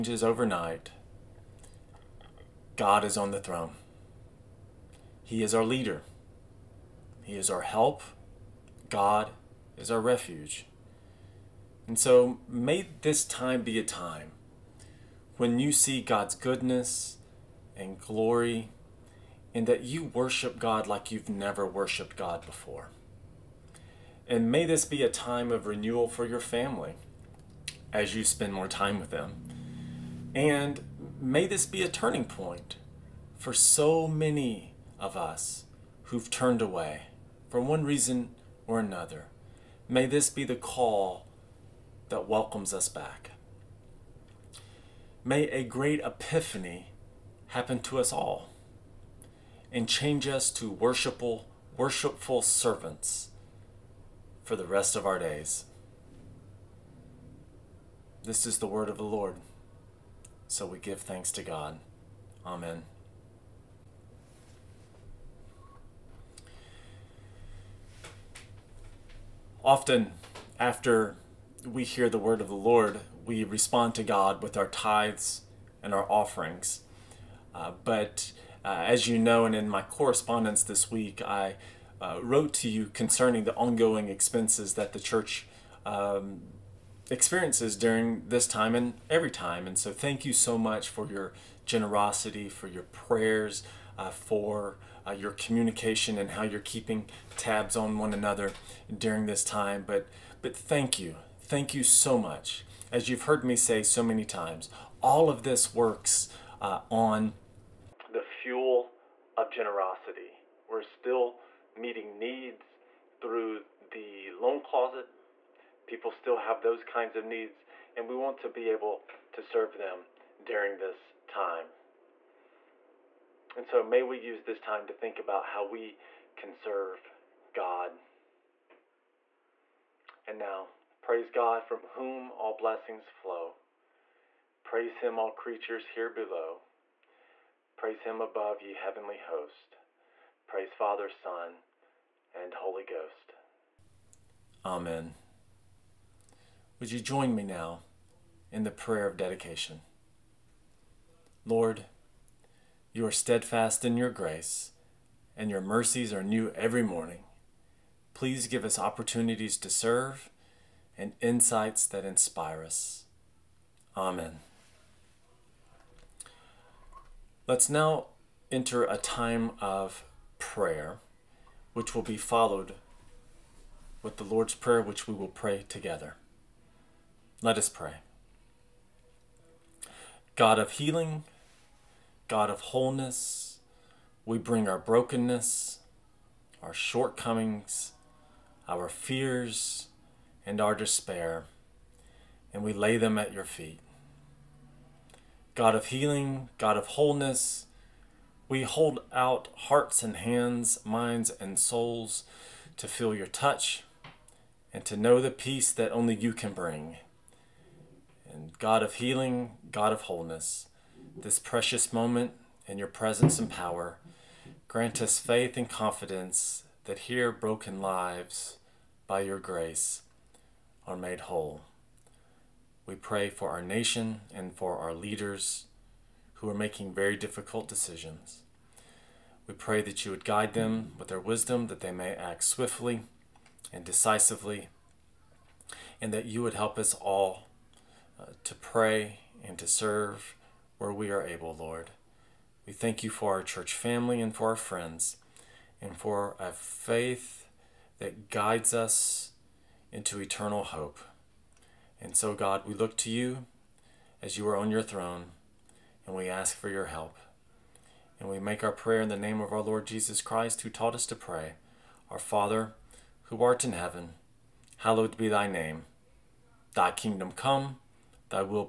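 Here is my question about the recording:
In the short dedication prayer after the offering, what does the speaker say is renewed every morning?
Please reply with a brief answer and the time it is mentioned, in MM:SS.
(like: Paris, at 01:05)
Your mercies, at 02:35.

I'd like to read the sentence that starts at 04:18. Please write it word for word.
And we make our prayer in the name of our Lord Jesus Christ, who taught us to pray.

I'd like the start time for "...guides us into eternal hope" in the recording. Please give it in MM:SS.
04:08.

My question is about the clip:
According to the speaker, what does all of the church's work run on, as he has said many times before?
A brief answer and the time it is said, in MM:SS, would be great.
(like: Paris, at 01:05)
Fuel of generosity, at 01:48.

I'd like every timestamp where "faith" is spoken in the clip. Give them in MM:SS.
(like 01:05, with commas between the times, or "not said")
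03:35, 04:06.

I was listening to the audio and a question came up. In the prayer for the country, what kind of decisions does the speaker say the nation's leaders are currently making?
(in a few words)
Very difficult decisions.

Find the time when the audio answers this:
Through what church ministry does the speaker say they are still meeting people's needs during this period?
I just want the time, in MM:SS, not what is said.
01:54.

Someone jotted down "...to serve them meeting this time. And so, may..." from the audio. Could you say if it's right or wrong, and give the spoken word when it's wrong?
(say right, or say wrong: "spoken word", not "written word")
wrong: "during", not "meeting".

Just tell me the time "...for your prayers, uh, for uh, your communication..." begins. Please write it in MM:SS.
01:32.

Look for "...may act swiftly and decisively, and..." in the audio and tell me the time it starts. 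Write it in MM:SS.
03:51.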